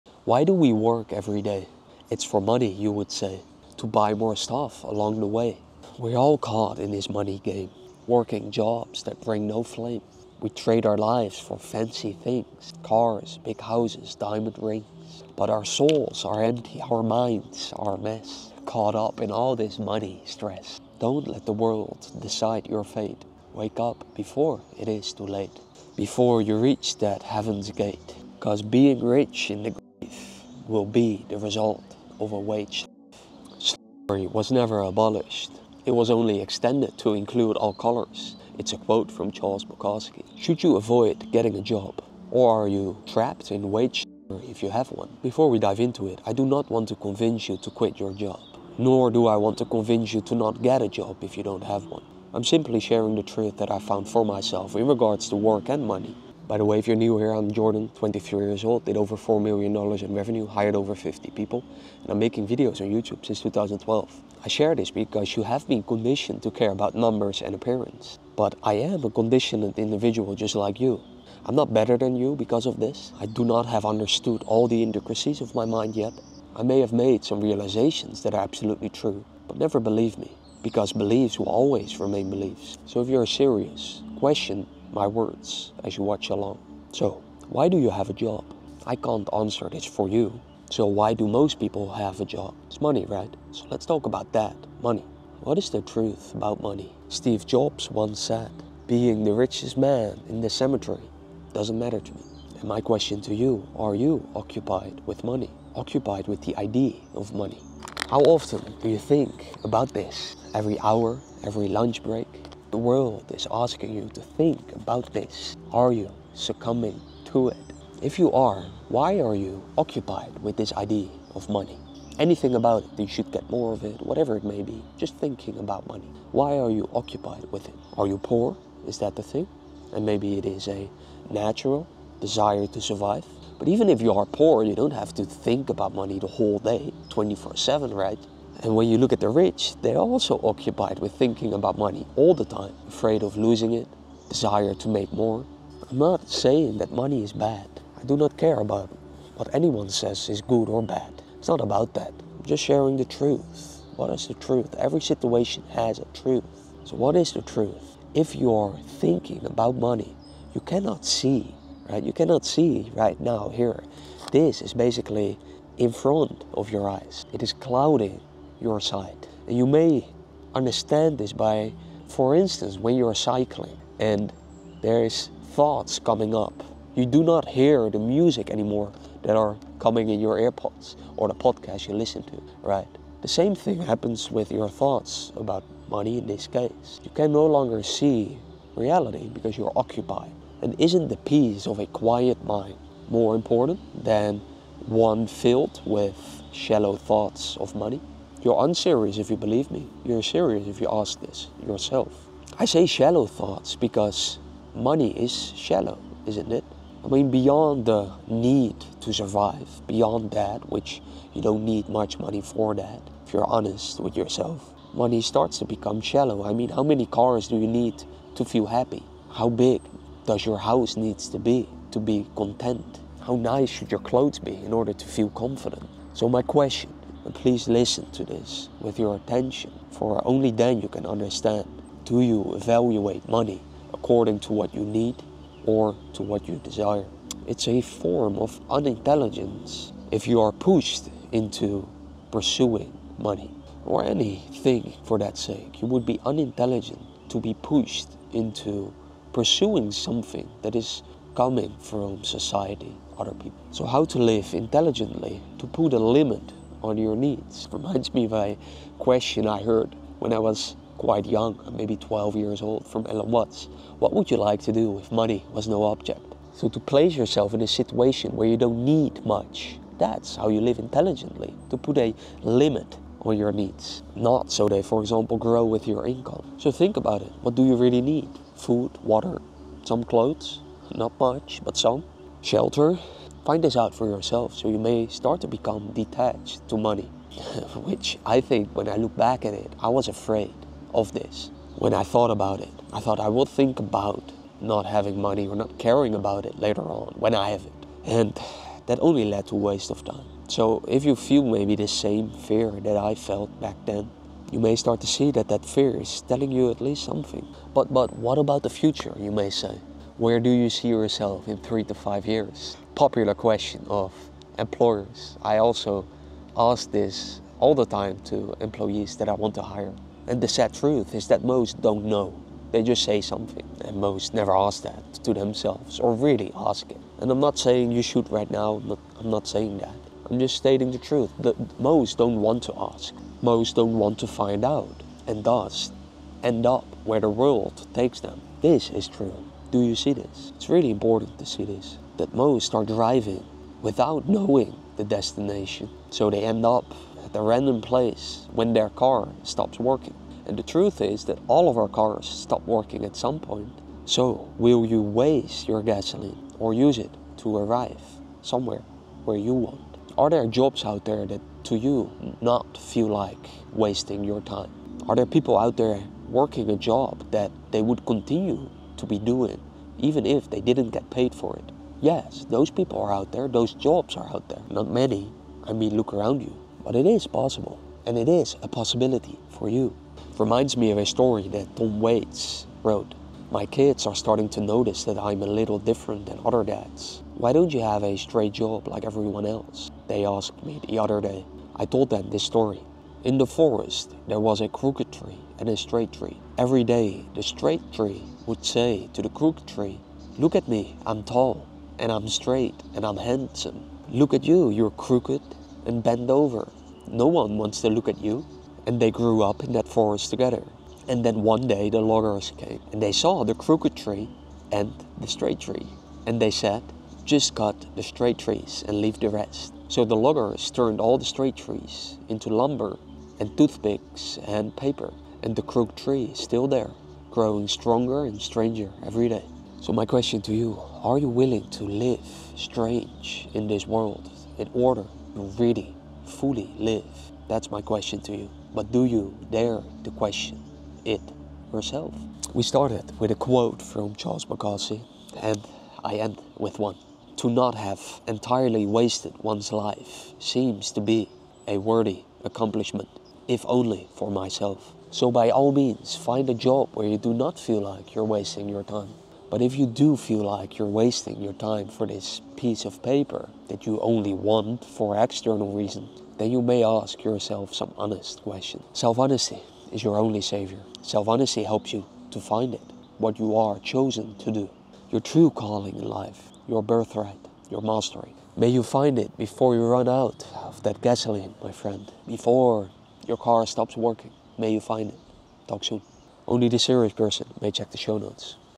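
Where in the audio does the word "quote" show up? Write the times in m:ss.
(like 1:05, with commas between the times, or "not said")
0:38, 7:23.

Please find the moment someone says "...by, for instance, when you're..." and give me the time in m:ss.
2:51.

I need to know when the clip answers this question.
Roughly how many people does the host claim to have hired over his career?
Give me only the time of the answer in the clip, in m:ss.
1:00.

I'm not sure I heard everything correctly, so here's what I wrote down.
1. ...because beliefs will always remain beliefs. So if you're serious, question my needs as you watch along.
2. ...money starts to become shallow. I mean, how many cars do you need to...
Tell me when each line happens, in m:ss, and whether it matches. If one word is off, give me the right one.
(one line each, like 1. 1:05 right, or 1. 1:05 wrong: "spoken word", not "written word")
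1. 1:20 wrong: "words", not "needs"
2. 3:34 right.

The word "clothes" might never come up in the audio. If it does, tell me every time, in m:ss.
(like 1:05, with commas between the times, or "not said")
3:43, 4:40.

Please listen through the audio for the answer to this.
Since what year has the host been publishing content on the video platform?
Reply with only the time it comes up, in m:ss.
1:03.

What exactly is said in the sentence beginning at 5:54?
So, will you waste your gasoline or use it to arrive somewhere where you want?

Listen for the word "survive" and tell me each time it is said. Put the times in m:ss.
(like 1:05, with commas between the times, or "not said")
2:12, 3:29.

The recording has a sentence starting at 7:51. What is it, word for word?
Self honesty helps you to find it, what you are chosen to do, your true calling in life, your birthright, your mastery.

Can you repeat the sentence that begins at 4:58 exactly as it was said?
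And that only led to waste of time.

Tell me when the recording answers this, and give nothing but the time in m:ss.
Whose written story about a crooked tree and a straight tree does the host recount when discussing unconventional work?
6:21.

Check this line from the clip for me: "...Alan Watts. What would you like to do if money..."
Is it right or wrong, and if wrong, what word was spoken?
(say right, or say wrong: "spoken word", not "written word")
right.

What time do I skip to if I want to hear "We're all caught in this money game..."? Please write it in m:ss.
0:05.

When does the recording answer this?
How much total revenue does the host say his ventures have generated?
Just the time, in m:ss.
0:59.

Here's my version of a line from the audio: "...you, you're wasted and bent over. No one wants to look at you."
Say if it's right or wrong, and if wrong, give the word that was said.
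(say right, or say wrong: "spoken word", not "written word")
wrong: "crooked", not "wasted".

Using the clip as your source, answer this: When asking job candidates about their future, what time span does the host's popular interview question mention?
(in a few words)
3 to 5 years.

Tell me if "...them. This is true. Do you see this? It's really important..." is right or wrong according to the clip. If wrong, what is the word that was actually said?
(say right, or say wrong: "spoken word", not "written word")
right.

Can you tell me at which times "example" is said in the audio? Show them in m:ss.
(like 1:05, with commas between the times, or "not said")
4:35.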